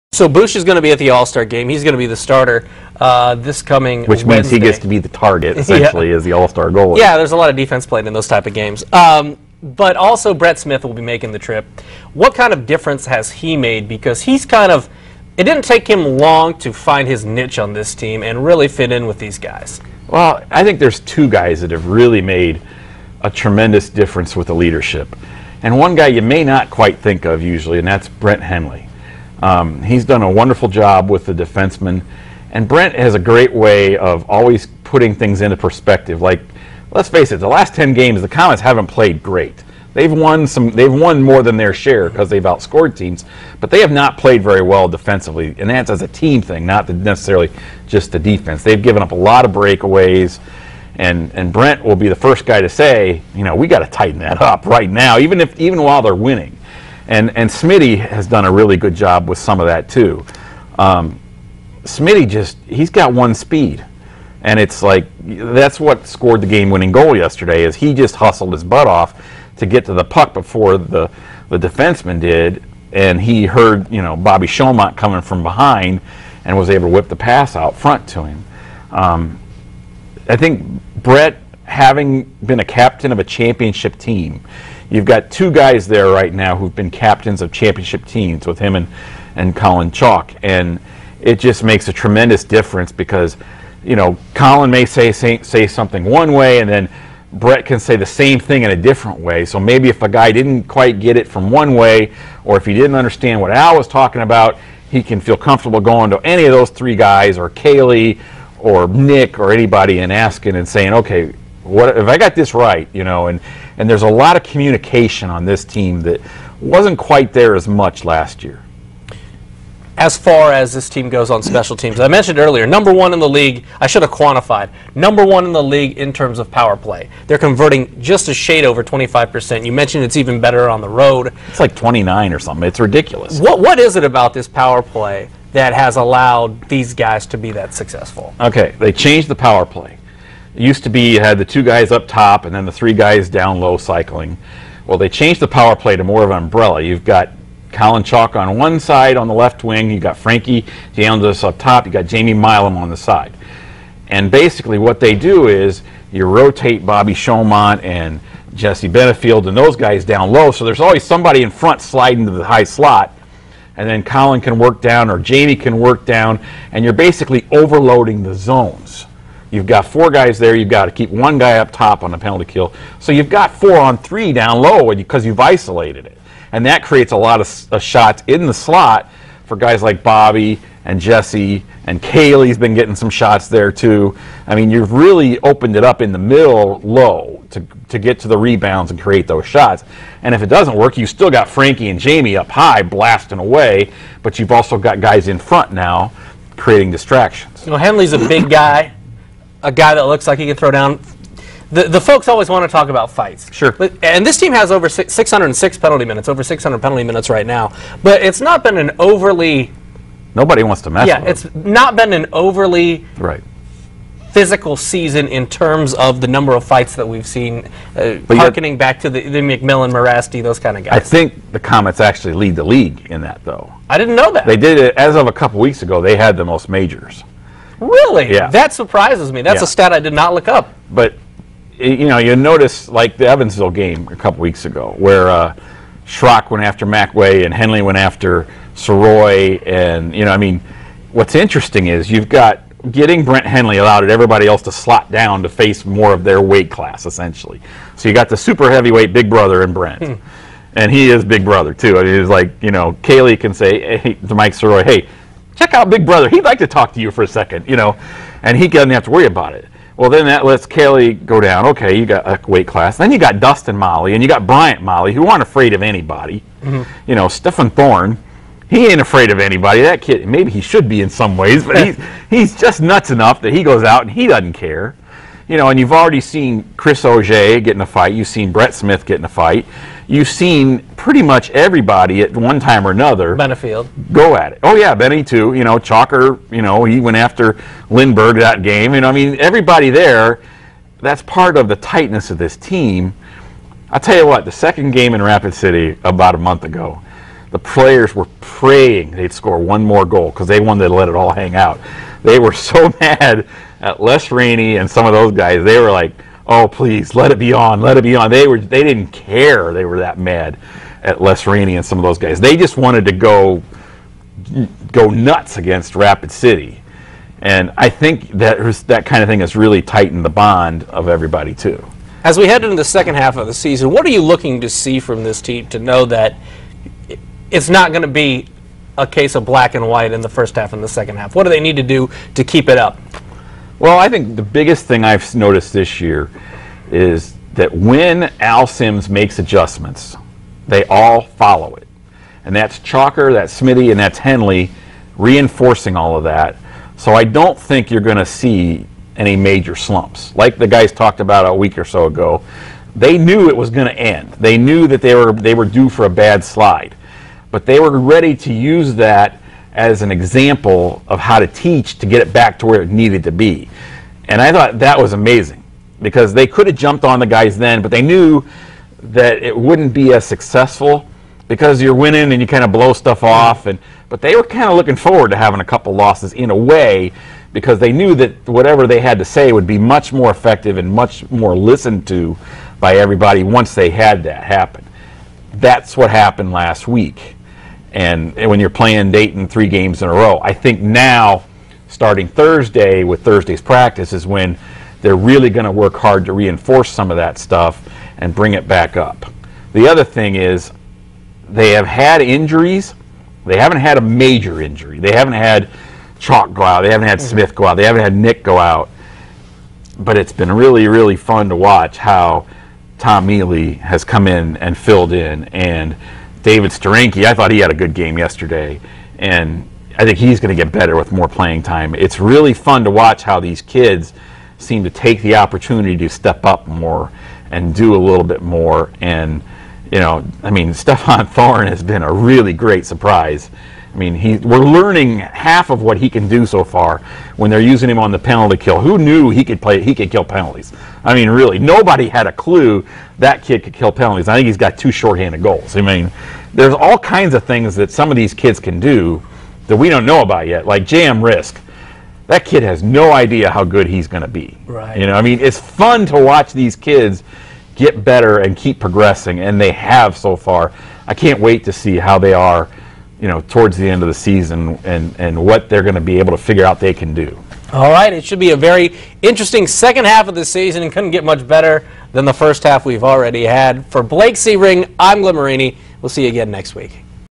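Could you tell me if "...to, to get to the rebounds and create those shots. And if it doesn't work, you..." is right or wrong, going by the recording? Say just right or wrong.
right.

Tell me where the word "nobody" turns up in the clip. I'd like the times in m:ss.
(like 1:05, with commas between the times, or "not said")
3:30, 7:21.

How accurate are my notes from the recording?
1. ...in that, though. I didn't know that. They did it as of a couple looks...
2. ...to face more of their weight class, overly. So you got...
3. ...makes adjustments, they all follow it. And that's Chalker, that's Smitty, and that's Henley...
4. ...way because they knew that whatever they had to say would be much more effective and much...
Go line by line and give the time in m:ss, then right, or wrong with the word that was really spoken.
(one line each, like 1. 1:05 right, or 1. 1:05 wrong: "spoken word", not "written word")
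1. 3:43 wrong: "weeks", not "looks"
2. 4:05 wrong: "essentially", not "overly"
3. 5:39 right
4. 6:16 right.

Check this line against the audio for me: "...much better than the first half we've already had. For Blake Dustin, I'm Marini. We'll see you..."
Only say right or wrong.
wrong.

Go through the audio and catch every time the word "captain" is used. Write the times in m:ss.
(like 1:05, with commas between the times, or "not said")
1:22, 1:26.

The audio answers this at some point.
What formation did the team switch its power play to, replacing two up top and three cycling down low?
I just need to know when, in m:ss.
2:26.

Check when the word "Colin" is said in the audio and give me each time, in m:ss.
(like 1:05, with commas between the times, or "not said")
1:29, 1:34, 2:27, 2:44.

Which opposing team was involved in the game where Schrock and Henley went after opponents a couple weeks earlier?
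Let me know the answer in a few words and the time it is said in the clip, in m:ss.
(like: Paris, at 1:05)
Evansville, at 3:53.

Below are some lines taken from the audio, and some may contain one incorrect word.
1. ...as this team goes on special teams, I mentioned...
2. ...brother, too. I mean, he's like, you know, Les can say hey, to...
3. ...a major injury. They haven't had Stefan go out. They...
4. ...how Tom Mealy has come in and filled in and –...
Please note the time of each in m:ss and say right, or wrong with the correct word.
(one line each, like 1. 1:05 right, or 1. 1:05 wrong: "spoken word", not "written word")
1. 2:00 right
2. 4:11 wrong: "Kaylee", not "Les"
3. 6:43 wrong: "Chalk", not "Stefan"
4. 6:51 right.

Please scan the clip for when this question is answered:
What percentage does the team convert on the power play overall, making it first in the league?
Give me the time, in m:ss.
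2:08.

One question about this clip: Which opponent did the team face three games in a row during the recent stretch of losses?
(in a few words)
Dayton.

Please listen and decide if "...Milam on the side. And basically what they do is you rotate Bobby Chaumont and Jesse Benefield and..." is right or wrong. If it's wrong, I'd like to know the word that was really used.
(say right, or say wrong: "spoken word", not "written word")
right.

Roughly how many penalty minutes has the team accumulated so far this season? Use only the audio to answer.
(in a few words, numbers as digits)
606.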